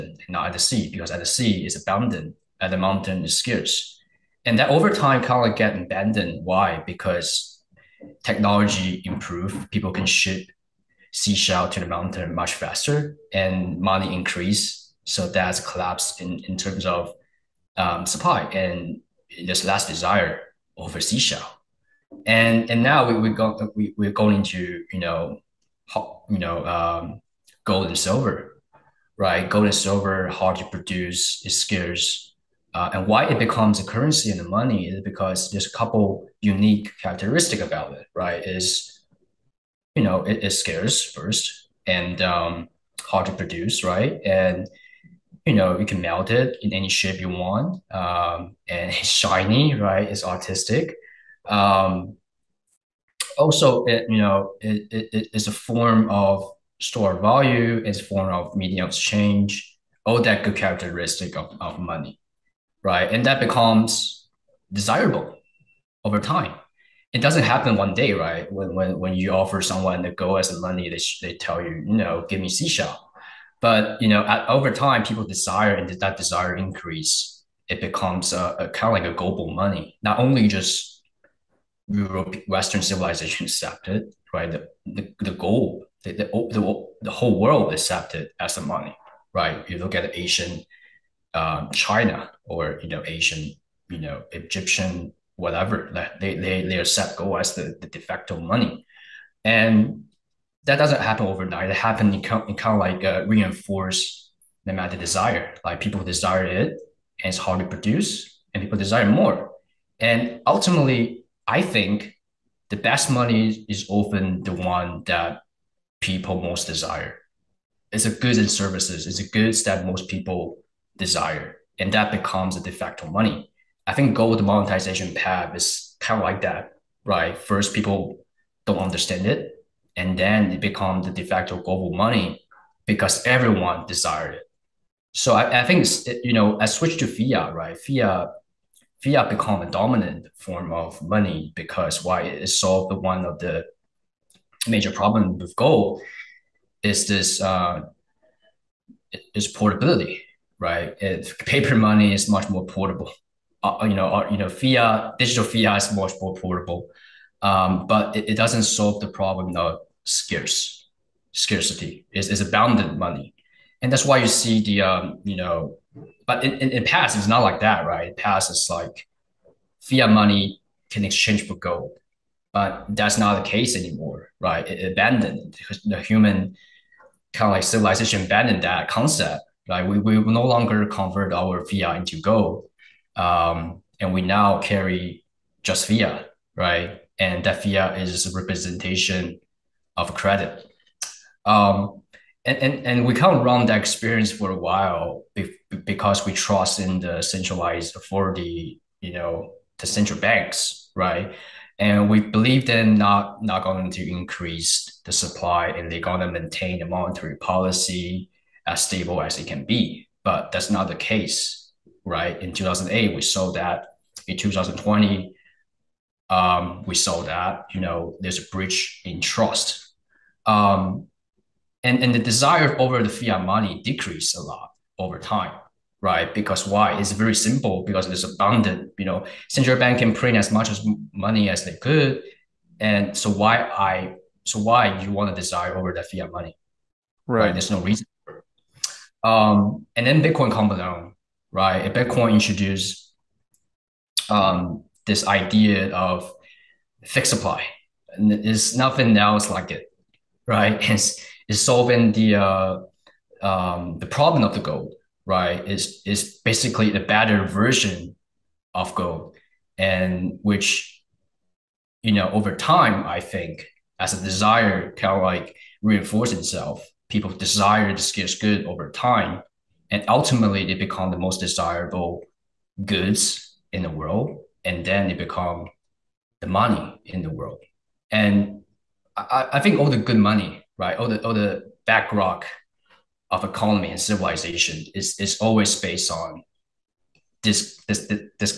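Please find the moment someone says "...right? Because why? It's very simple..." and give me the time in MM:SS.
03:46.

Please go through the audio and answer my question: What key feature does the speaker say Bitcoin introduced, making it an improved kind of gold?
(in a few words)
Fixed supply.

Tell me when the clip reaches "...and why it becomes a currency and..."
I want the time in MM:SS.
00:32.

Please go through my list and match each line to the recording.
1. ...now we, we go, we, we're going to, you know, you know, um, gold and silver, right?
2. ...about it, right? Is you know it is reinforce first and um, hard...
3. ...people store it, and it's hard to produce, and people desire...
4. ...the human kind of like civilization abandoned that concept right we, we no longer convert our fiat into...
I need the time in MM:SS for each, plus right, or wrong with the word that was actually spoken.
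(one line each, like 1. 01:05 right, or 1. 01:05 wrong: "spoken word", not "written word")
1. 00:22 right
2. 00:37 wrong: "scarce", not "reinforce"
3. 01:45 wrong: "desire", not "store"
4. 02:55 right.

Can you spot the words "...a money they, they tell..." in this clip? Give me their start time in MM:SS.
01:10.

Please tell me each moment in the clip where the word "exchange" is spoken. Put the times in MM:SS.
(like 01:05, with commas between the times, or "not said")
00:58, 02:51.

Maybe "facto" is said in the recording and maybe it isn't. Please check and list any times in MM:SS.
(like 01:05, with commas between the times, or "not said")
01:37, 02:02, 02:11.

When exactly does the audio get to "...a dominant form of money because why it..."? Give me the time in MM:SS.
02:19.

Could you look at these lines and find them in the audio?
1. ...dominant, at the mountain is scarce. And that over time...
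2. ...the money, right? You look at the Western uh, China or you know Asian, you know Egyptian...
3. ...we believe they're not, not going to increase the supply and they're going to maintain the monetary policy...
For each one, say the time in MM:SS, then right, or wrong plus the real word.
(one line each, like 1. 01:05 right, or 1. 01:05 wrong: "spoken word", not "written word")
1. 00:01 wrong: "abundant", not "dominant"
2. 01:28 wrong: "Asian", not "Western"
3. 03:22 right.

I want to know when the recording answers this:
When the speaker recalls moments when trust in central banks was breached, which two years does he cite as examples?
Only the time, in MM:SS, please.
03:32.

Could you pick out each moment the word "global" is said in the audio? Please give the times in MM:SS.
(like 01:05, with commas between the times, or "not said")
01:19, 02:11.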